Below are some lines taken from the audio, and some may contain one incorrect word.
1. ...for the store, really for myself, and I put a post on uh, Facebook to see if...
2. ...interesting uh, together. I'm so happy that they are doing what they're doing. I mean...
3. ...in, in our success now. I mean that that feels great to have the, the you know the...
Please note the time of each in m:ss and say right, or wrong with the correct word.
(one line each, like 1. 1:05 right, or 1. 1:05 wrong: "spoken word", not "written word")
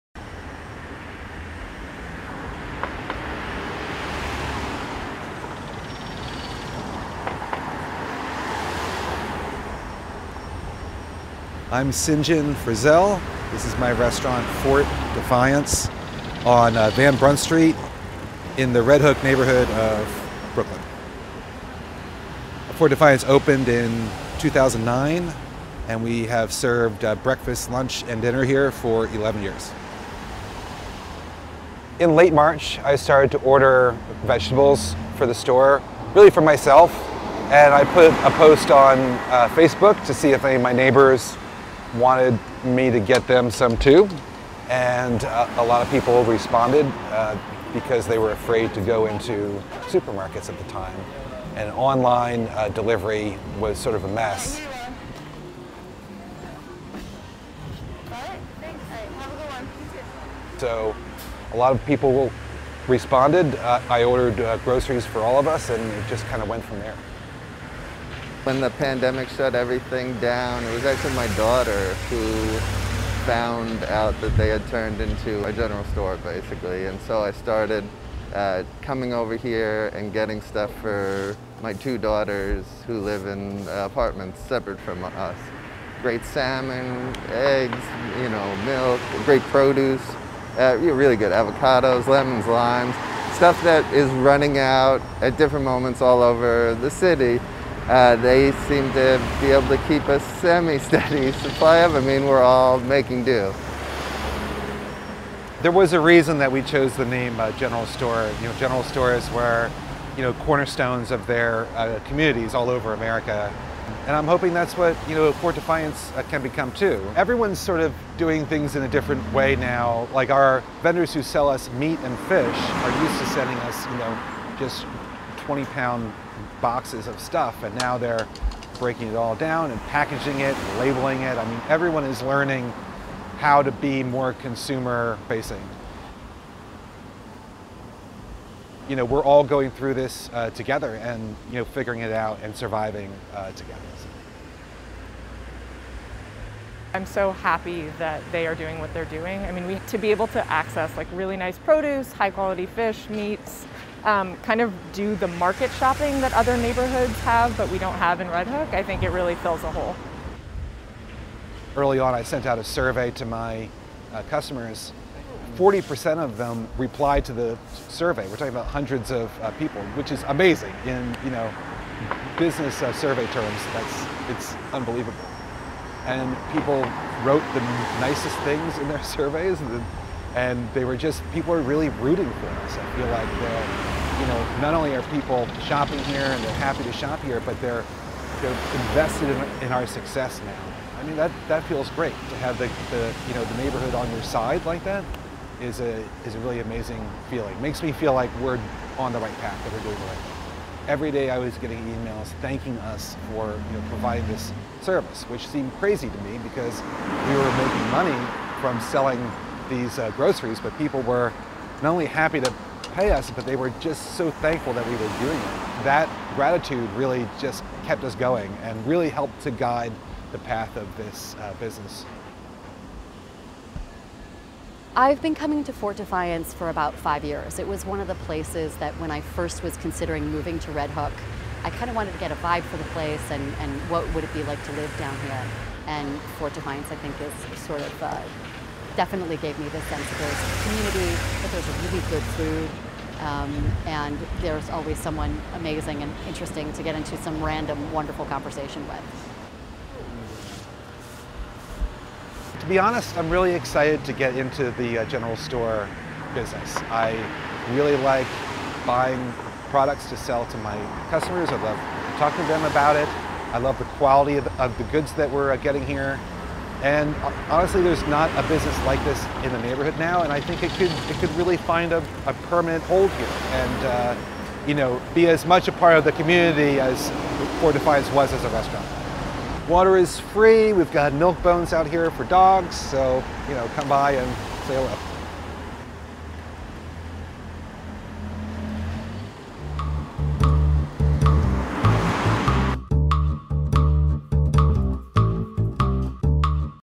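1. 0:35 right
2. 2:22 wrong: "surviving", not "interesting"
3. 3:09 right.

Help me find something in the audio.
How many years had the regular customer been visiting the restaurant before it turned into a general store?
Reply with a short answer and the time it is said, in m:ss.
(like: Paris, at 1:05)
5 years, at 3:46.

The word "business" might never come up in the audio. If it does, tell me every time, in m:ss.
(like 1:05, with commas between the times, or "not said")
2:52, 3:41, 4:16, 4:28.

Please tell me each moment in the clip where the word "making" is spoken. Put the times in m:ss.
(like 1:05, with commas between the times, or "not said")
1:42, 3:27.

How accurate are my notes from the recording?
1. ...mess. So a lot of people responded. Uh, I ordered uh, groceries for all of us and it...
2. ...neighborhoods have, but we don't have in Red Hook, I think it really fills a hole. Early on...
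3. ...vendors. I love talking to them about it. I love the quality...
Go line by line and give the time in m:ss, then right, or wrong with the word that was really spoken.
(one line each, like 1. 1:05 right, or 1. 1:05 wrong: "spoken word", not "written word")
1. 0:54 right
2. 2:36 right
3. 4:21 wrong: "customers", not "vendors".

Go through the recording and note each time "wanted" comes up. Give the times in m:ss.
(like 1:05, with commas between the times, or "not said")
0:41, 3:51.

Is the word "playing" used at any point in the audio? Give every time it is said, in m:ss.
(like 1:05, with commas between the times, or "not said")
not said.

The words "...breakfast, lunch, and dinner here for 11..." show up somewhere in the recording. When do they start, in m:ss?
0:27.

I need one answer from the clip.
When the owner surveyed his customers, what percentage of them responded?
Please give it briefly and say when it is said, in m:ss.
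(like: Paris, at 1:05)
40%, at 2:45.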